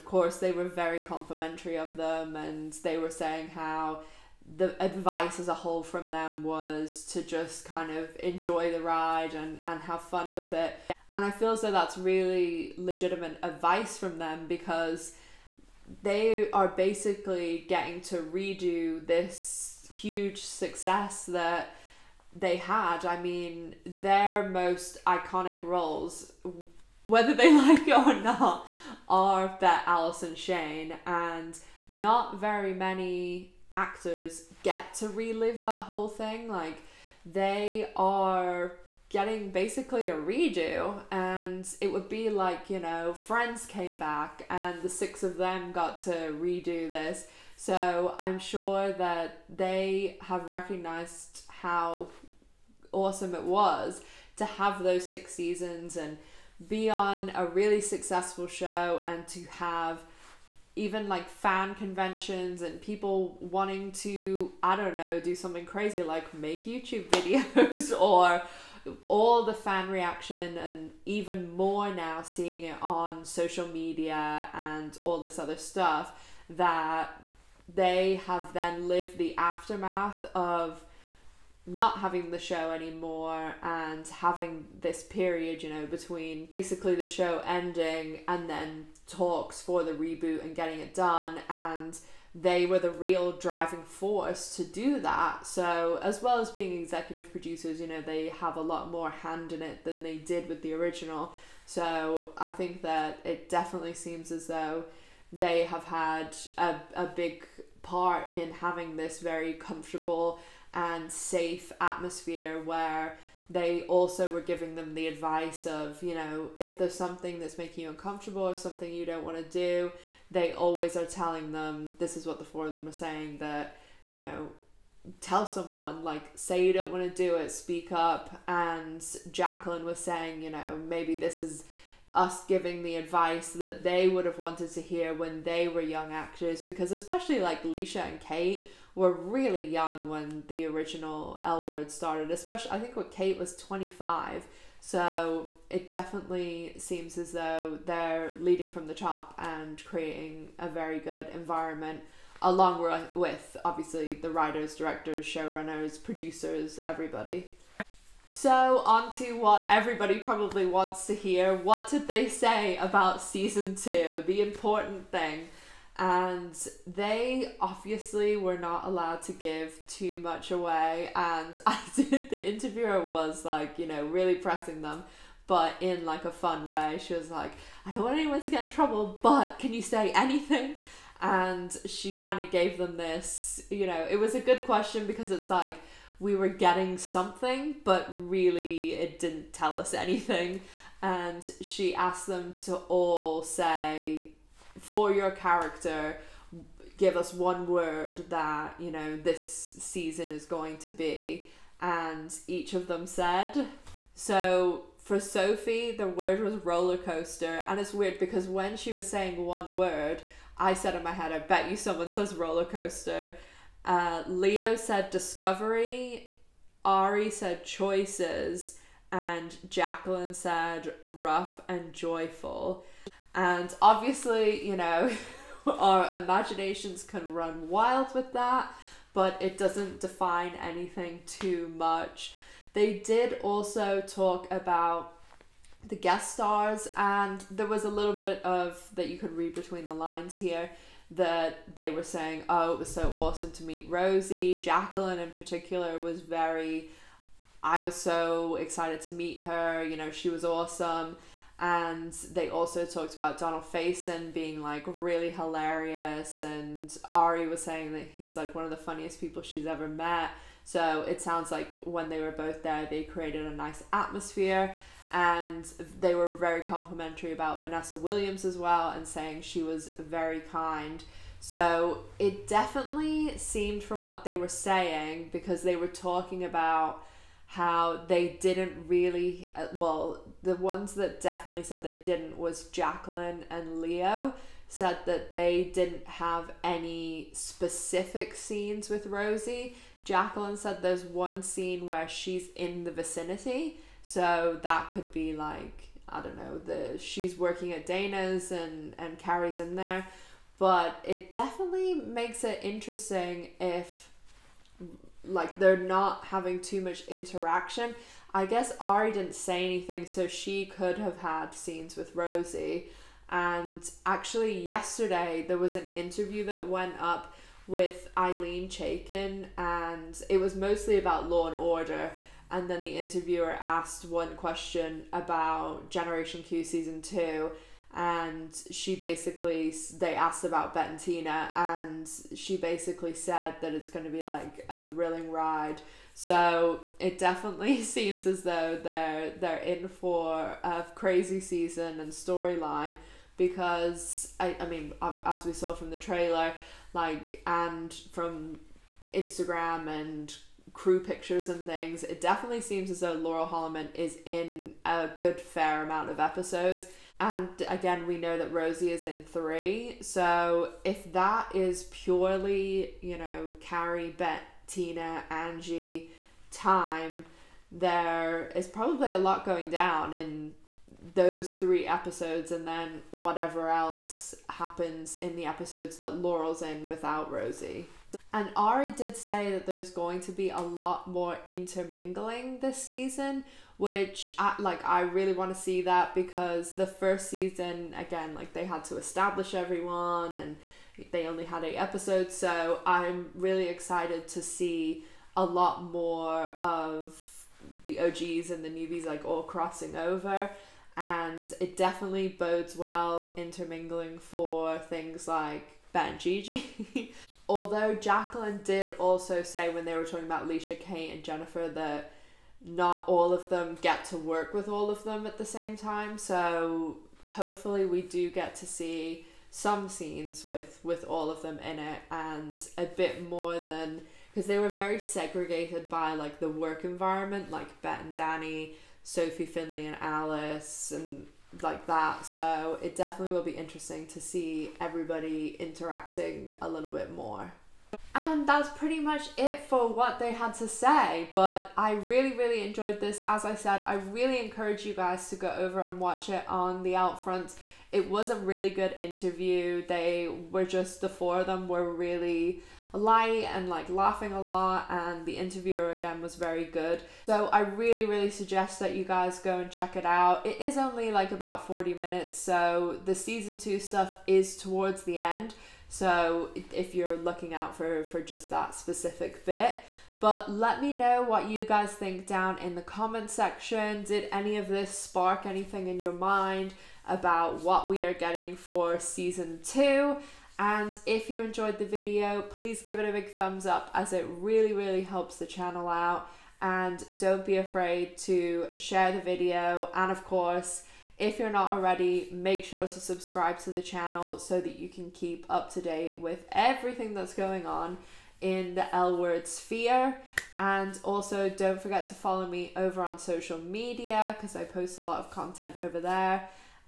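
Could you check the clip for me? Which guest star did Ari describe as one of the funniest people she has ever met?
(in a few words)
Donald Faison.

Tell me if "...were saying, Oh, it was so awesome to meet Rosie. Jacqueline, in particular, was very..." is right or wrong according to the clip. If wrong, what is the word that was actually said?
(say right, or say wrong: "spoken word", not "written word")
right.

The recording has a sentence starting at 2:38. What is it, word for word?
So, on to what everybody probably wants to hear.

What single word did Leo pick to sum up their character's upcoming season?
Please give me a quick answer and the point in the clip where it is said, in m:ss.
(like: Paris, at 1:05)
Discovery, at 3:35.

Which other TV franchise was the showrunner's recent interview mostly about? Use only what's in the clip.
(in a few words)
Law and Order.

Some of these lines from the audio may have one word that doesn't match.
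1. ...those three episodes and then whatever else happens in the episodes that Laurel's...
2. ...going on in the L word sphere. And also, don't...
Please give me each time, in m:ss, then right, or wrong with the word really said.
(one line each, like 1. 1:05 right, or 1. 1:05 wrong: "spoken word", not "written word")
1. 6:11 right
2. 8:17 right.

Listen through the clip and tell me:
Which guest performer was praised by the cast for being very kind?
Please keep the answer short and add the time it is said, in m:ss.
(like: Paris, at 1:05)
Vanessa Williams, at 4:27.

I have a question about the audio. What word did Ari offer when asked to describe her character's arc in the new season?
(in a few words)
Choices.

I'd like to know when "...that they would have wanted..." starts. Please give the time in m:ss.
2:13.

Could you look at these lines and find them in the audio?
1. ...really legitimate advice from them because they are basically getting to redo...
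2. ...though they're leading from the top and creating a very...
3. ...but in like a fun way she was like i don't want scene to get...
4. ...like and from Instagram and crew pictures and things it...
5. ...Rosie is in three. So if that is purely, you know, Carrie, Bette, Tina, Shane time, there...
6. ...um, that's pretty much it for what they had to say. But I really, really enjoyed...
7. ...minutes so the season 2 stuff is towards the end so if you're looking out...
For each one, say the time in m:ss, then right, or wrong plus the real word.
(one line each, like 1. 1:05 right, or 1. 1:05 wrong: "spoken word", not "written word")
1. 0:11 right
2. 2:27 right
3. 2:55 wrong: "anyone", not "scene"
4. 5:46 right
5. 5:58 wrong: "Angie", not "Shane"
6. 7:18 right
7. 7:41 right.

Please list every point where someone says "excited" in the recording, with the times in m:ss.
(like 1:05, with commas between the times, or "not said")
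4:08, 6:33.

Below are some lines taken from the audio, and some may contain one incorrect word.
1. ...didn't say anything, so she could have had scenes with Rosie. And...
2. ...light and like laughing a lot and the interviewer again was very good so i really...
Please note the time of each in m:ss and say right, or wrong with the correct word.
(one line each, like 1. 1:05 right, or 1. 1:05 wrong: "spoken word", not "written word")
1. 5:09 right
2. 7:32 right.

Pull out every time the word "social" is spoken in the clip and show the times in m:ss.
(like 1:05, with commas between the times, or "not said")
1:13, 8:23.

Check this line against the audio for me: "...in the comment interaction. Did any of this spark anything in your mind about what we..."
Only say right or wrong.
wrong.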